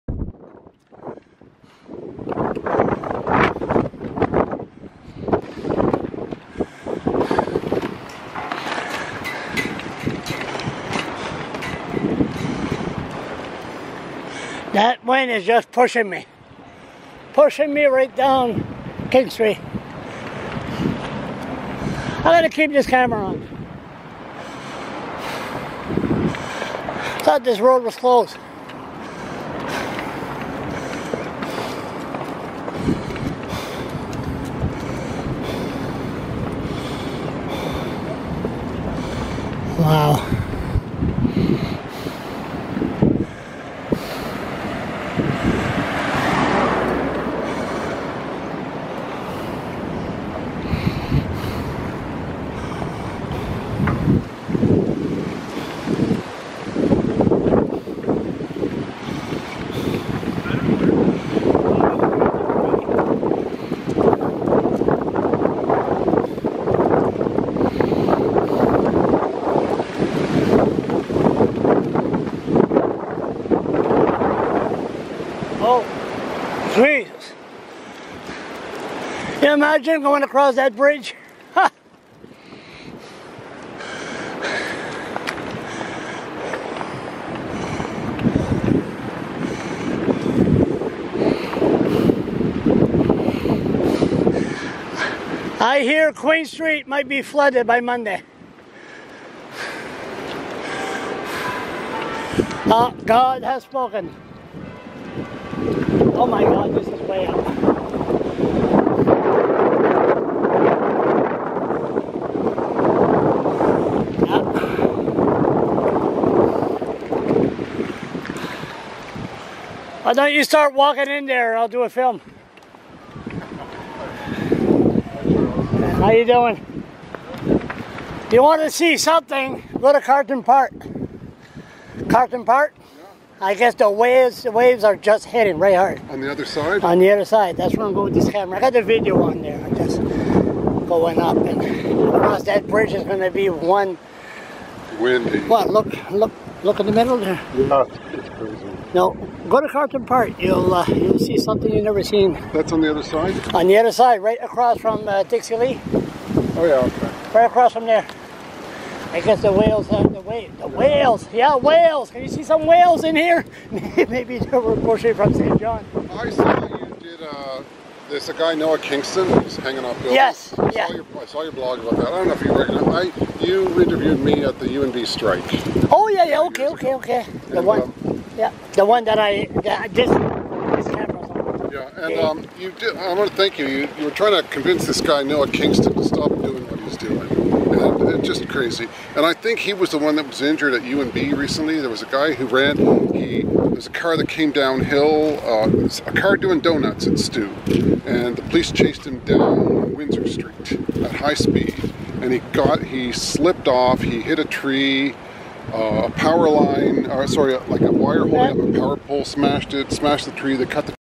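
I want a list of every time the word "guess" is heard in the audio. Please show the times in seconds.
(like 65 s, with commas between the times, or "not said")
133 s, 159 s.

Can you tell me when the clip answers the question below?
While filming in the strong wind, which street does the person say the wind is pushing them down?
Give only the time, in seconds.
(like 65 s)
19 s.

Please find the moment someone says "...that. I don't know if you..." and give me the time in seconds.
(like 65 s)
171 s.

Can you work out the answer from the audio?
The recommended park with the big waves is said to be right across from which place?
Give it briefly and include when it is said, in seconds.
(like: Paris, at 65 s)
Dixie Lee, at 155 s.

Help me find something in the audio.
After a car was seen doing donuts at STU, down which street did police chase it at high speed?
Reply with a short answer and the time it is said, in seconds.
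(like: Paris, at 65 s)
Windsor Street, at 199 s.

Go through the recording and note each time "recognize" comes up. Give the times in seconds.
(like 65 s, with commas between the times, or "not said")
172 s.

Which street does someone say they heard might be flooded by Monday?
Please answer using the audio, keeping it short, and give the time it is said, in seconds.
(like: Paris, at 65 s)
Queen Street, at 96 s.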